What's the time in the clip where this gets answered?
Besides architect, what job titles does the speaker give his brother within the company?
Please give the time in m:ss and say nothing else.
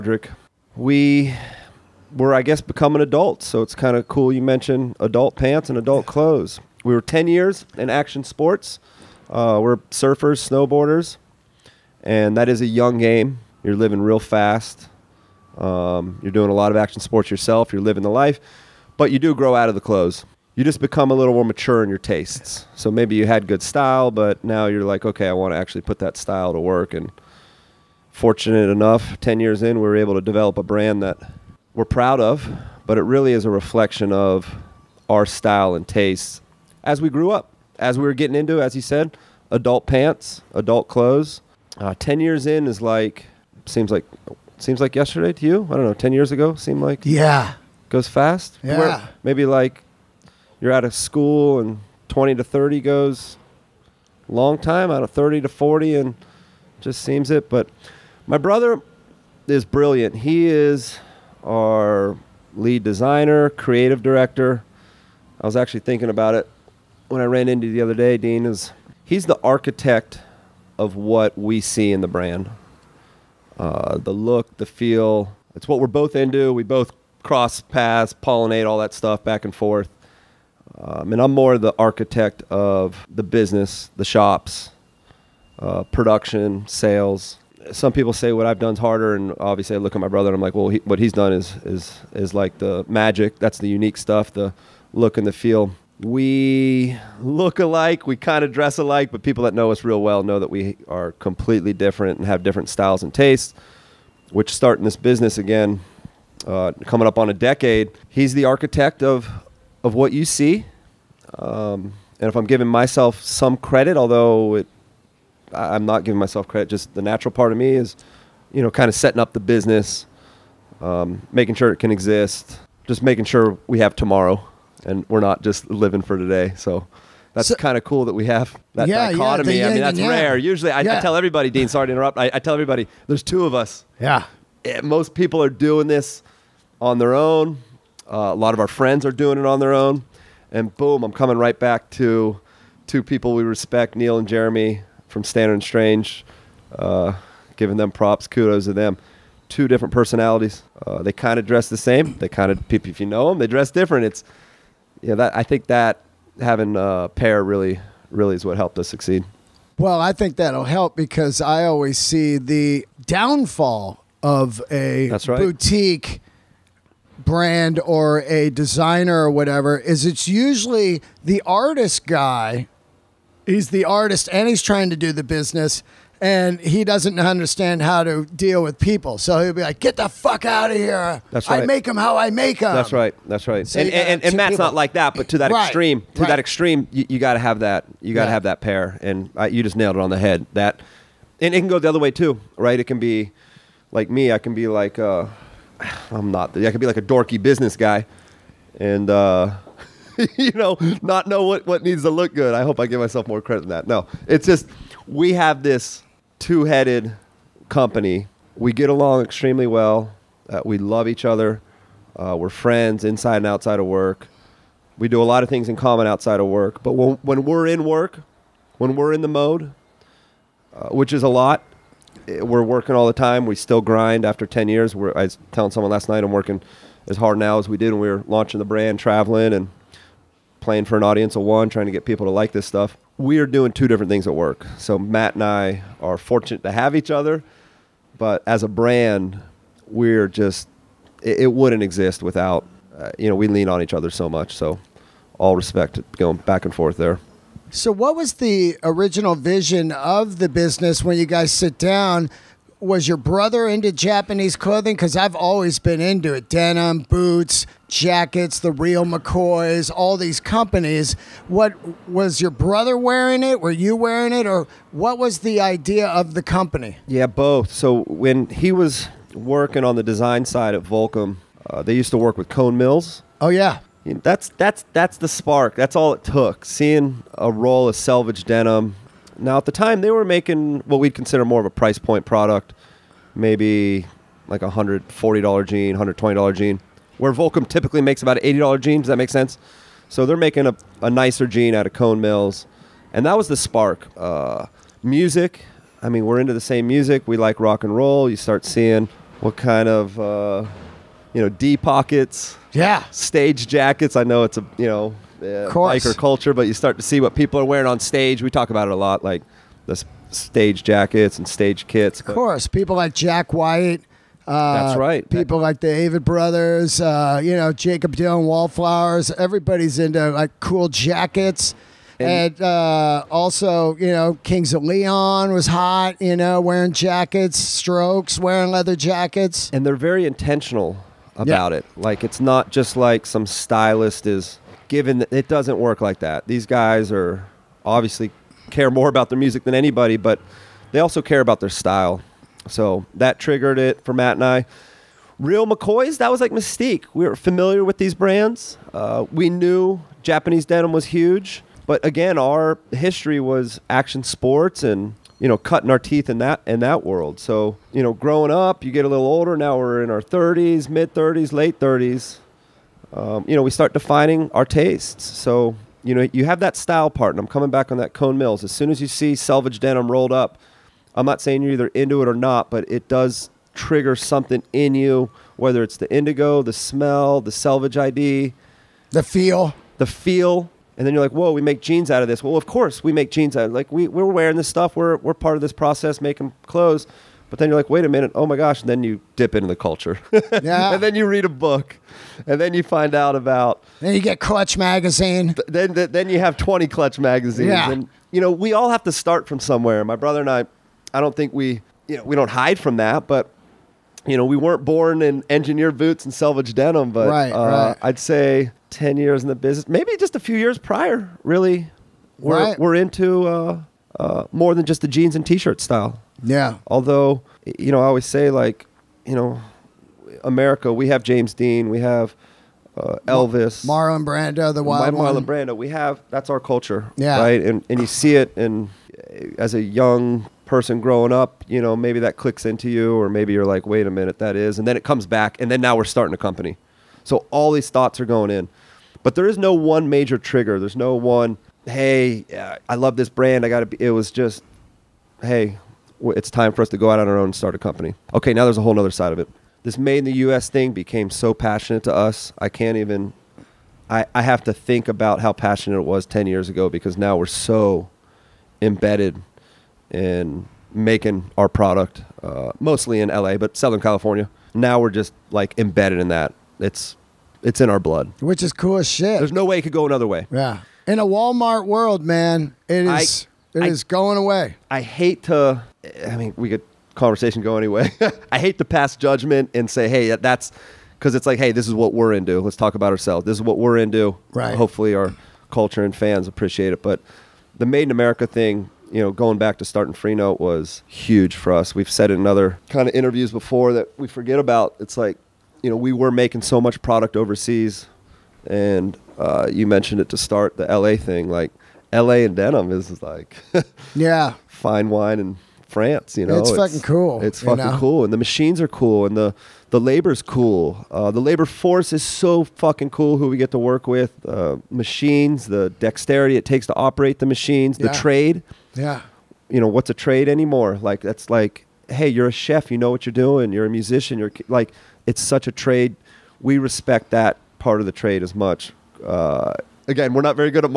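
1:02.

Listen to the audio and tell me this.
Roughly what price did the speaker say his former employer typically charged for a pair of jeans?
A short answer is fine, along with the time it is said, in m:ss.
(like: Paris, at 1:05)
$80, at 4:48.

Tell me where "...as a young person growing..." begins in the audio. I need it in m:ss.
7:09.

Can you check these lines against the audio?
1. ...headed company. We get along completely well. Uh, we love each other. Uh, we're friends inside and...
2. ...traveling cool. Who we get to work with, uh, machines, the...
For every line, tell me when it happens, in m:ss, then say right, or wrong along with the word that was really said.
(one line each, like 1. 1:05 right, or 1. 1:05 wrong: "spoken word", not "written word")
1. 3:26 wrong: "extremely", not "completely"
2. 8:32 wrong: "fucking", not "traveling".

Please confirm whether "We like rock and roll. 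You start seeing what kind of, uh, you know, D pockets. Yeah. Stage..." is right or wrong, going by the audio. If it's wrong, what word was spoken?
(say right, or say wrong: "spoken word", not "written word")
right.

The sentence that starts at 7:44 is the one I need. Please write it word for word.
Now we're just like embedded in that.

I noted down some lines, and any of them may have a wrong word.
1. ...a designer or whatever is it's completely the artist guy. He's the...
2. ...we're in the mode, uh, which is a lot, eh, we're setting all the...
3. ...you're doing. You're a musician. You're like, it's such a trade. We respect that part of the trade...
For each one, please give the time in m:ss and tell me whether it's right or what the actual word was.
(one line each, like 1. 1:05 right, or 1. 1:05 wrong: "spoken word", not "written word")
1. 2:48 wrong: "usually", not "completely"
2. 3:38 wrong: "working", not "setting"
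3. 8:43 right.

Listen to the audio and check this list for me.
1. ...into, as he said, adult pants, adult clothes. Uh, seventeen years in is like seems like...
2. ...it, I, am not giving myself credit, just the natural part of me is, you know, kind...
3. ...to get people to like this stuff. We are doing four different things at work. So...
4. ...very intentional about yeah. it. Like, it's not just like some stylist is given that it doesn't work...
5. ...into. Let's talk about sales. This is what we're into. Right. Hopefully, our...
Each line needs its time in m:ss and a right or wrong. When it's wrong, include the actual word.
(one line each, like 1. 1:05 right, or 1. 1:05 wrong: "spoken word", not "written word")
1. 0:38 wrong: "ten", not "seventeen"
2. 1:54 right
3. 3:51 wrong: "two", not "four"
4. 5:29 right
5. 8:02 wrong: "ourselves", not "sales".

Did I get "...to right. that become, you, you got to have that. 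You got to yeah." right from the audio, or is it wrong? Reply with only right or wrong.
wrong.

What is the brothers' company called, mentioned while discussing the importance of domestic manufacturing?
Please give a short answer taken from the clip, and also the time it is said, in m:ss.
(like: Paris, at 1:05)
Freenote, at 8:10.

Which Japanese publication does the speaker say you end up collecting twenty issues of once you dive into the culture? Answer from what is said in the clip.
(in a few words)
Clutch Magazine.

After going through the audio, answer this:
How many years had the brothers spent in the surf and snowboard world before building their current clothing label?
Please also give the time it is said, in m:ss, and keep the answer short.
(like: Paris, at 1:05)
10, at 0:07.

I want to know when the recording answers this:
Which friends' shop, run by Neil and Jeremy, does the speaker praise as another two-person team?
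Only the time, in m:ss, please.
2:25.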